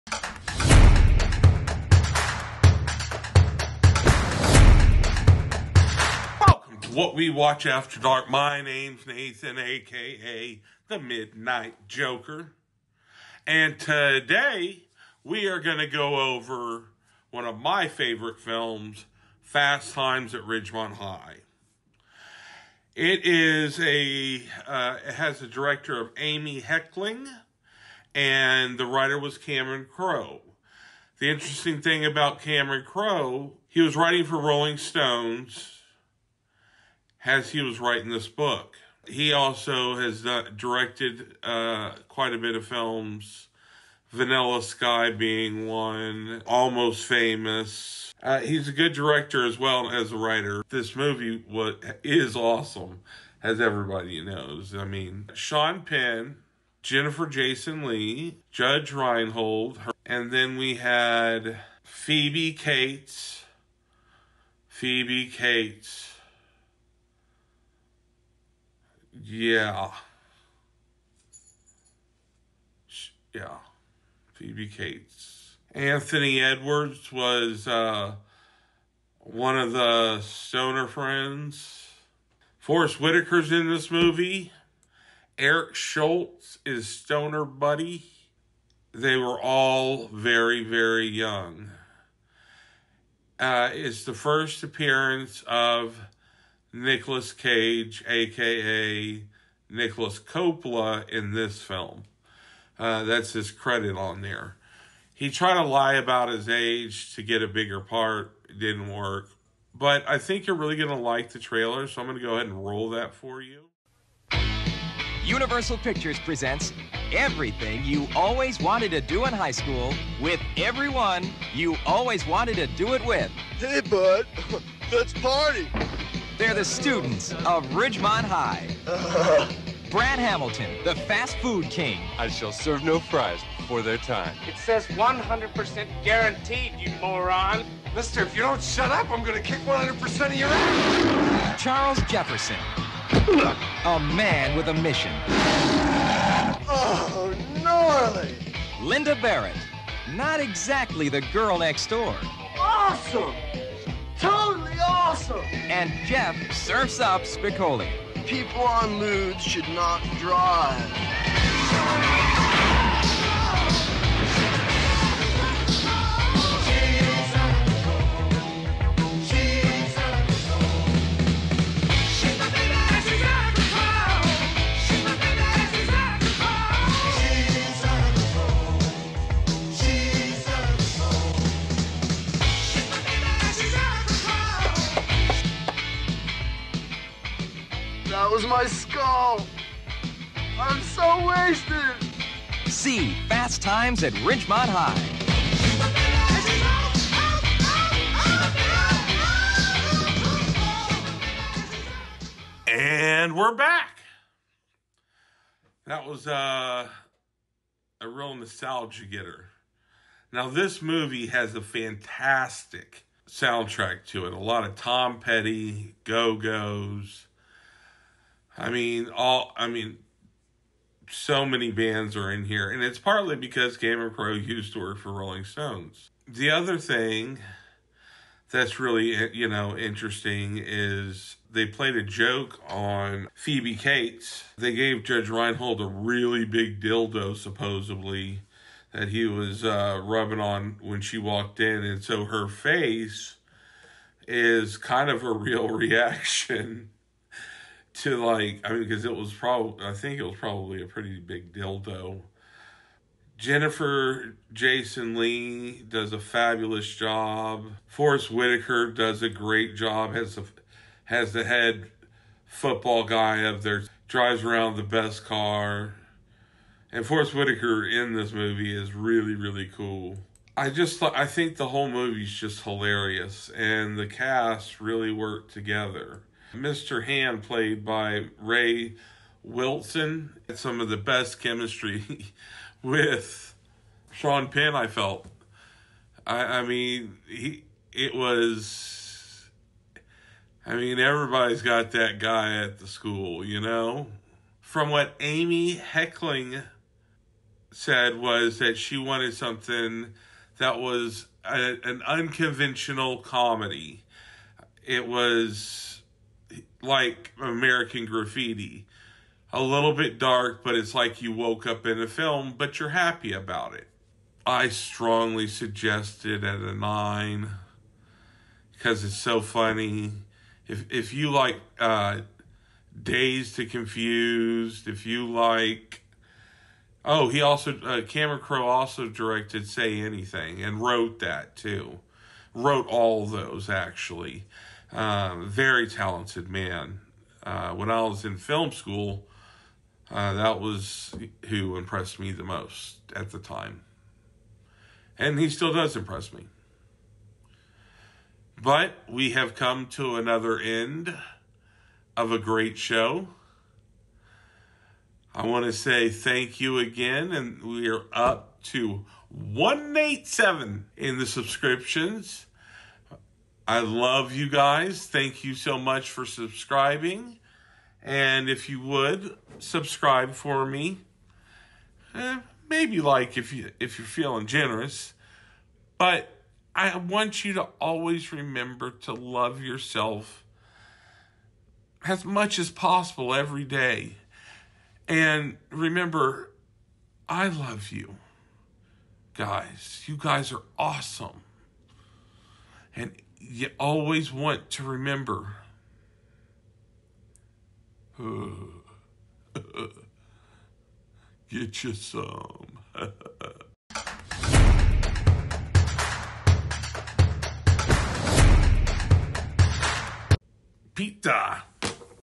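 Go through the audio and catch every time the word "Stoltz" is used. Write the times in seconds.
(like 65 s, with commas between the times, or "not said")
85 s.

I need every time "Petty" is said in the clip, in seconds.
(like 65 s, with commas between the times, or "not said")
215 s.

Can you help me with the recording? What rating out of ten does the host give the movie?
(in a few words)
9.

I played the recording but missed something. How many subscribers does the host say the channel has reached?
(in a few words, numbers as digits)
187.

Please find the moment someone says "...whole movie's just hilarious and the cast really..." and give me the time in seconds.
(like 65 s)
271 s.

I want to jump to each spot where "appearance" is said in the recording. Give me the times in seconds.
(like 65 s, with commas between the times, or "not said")
94 s.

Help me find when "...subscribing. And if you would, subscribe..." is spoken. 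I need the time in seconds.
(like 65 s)
366 s.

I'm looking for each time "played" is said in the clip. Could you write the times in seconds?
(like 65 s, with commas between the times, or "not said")
231 s, 277 s.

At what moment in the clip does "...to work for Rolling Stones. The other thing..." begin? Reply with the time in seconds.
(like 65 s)
224 s.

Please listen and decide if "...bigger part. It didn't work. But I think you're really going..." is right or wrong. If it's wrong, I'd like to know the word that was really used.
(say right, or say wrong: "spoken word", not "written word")
right.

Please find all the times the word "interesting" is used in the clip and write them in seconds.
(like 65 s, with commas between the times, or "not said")
31 s, 229 s.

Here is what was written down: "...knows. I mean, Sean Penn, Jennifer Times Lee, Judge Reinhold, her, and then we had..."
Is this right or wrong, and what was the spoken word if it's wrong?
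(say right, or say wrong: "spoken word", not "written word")
wrong: "Jason", not "Times".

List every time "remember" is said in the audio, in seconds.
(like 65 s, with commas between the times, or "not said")
378 s, 385 s, 394 s.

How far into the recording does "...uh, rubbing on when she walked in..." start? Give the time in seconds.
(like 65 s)
239 s.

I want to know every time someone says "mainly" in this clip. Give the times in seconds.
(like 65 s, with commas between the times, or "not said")
not said.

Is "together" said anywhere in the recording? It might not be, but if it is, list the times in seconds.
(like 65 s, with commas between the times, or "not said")
275 s.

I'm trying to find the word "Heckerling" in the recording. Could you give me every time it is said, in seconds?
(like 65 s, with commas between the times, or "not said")
26 s, 295 s.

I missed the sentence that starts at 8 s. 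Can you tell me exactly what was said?
My name's Nathan, aka the Midnight Joker.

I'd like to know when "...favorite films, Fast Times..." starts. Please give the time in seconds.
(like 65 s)
17 s.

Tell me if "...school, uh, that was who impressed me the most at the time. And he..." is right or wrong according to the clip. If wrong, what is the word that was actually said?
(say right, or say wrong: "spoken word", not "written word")
right.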